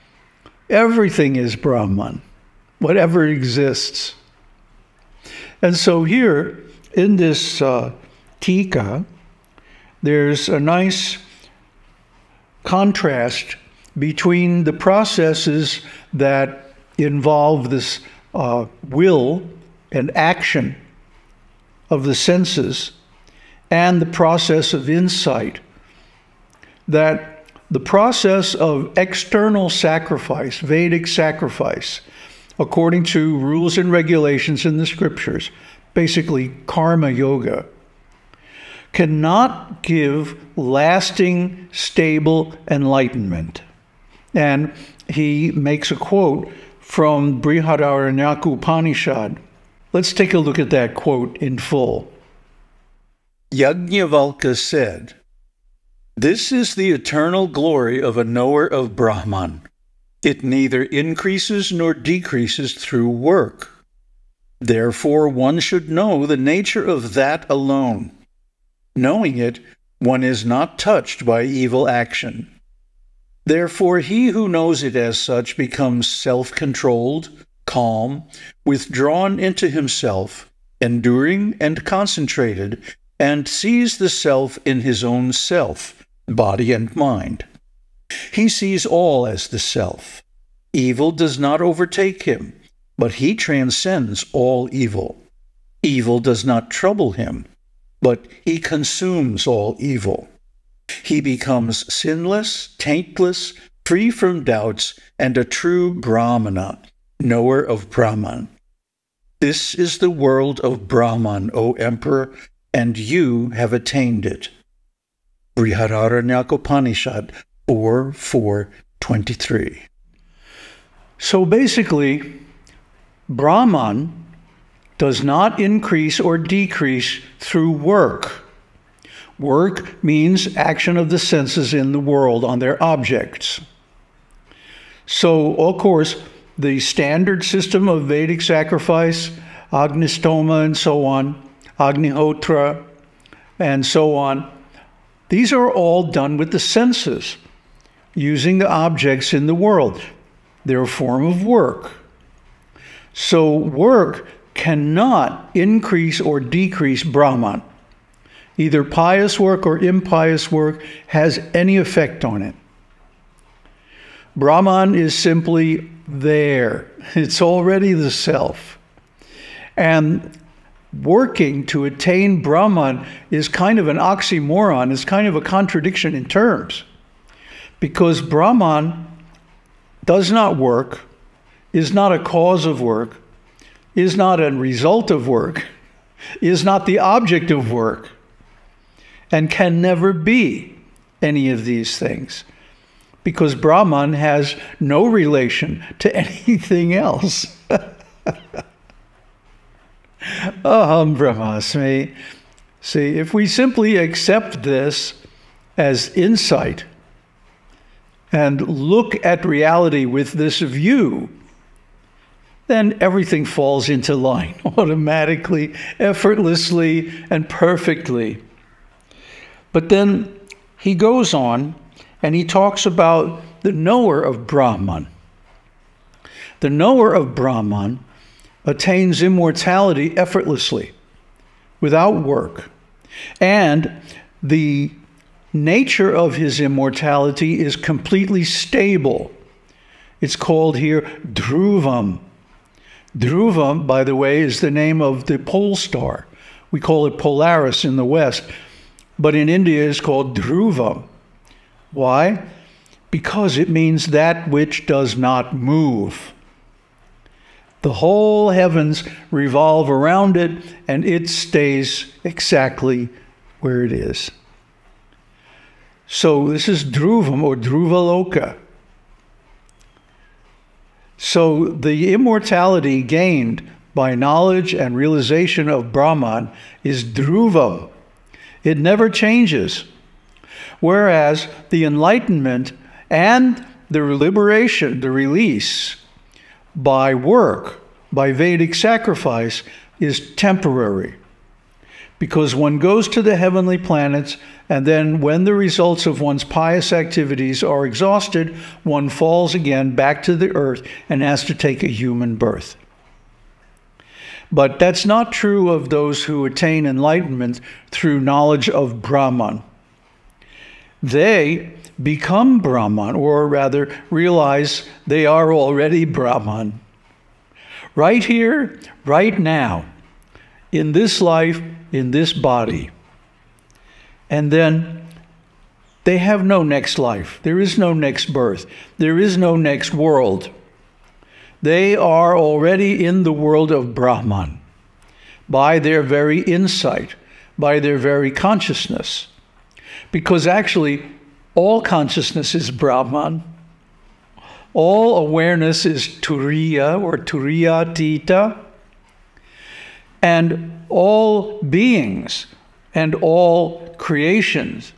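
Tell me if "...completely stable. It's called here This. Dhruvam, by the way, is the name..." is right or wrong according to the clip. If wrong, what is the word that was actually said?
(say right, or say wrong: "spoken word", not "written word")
wrong: "Dhruvam", not "This".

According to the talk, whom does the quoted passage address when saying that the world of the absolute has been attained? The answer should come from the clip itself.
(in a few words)
Emperor.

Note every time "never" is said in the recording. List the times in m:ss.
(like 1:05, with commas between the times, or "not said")
3:09, 4:38.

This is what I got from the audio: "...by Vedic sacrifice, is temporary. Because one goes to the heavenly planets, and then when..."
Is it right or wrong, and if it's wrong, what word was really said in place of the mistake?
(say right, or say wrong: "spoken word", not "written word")
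right.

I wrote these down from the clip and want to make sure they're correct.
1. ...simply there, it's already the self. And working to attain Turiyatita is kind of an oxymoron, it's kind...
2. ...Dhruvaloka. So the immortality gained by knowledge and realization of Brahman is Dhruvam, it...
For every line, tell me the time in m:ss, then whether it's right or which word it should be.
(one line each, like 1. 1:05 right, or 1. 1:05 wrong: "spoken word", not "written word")
1. 2:45 wrong: "Brahman", not "Turiyatita"
2. 4:27 right.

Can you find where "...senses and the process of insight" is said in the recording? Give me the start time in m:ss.
0:22.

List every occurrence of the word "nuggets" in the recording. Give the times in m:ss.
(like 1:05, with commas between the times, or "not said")
not said.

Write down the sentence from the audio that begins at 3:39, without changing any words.
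But then he goes on and he talks about the knower of Brahman.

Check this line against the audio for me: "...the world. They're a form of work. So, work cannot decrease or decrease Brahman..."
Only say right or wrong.
wrong.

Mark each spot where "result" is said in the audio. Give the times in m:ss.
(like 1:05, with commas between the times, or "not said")
3:04, 4:55.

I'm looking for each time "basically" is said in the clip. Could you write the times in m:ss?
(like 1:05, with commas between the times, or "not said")
0:35, 2:01.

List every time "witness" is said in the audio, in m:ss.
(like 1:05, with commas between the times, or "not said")
not said.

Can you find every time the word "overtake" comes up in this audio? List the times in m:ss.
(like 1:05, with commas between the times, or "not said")
1:31.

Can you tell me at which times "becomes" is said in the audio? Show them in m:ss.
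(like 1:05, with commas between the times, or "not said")
1:15, 1:41, 5:12.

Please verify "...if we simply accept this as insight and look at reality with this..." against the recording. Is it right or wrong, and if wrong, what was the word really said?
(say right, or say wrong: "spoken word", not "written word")
right.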